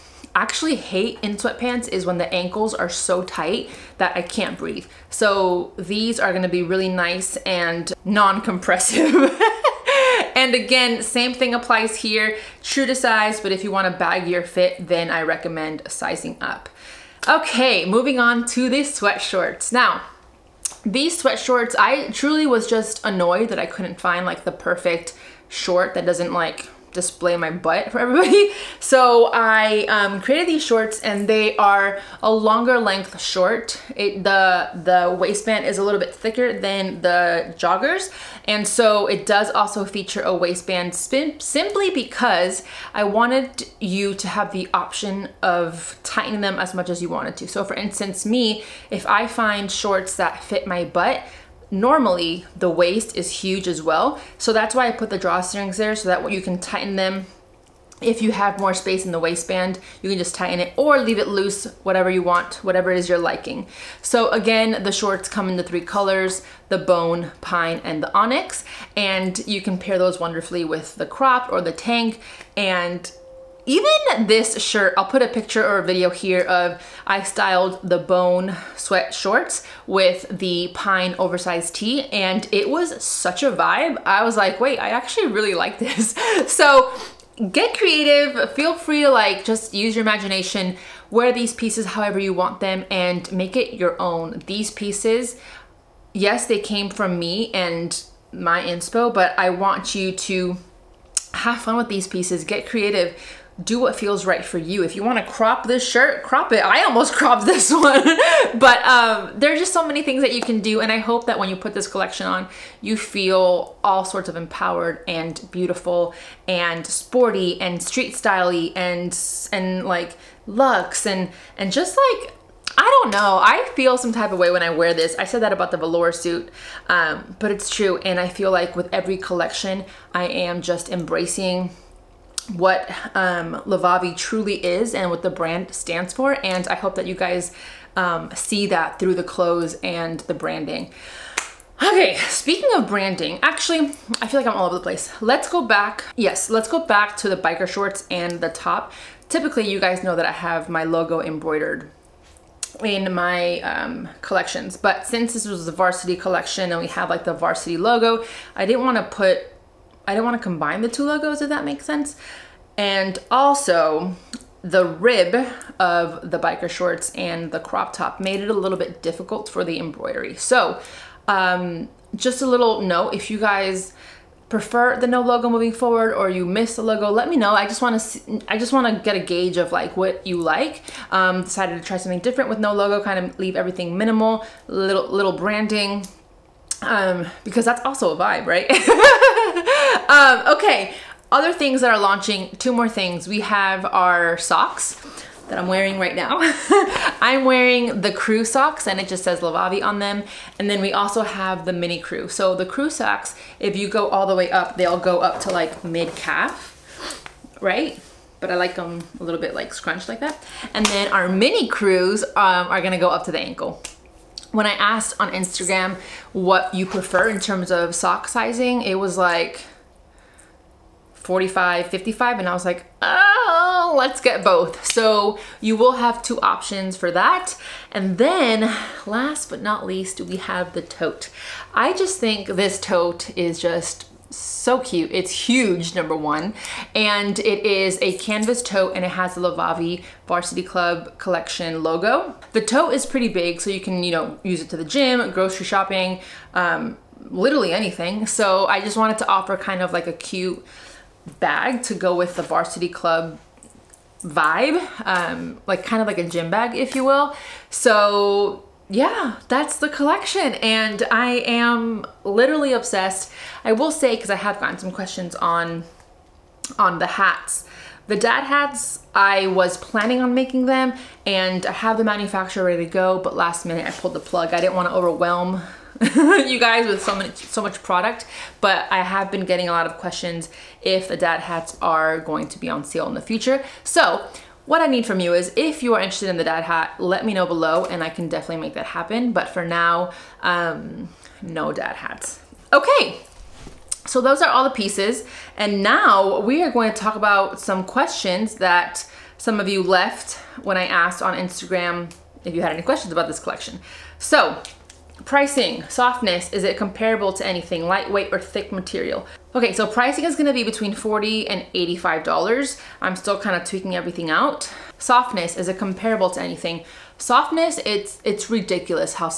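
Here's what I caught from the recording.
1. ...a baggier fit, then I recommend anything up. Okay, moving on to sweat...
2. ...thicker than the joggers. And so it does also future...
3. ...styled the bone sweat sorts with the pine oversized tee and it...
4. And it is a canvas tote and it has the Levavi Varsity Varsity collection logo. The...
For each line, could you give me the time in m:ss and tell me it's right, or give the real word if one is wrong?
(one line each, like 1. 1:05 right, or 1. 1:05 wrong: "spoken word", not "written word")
1. 0:13 wrong: "sizing", not "anything"
2. 0:36 wrong: "feature", not "future"
3. 1:17 wrong: "shorts", not "sorts"
4. 3:56 wrong: "Club", not "Varsity".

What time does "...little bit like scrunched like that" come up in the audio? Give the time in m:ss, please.
3:29.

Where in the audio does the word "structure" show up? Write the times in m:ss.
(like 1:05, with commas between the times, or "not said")
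not said.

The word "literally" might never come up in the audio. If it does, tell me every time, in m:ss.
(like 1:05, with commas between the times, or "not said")
4:07, 4:22.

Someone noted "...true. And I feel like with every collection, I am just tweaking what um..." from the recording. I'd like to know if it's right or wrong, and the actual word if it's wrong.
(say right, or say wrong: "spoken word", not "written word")
wrong: "embracing", not "tweaking".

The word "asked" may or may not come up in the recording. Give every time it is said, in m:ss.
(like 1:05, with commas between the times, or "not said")
3:34, 5:00.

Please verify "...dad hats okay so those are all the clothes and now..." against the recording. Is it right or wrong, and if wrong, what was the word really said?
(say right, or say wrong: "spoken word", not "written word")
wrong: "pieces", not "clothes".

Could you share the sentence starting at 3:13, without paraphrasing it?
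We have our socks that I'm wearing right now.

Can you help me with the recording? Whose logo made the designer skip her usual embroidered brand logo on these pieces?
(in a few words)
Varsity collection.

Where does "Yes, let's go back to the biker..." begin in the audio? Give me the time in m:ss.
2:26.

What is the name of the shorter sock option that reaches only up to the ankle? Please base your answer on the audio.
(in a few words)
mini crew.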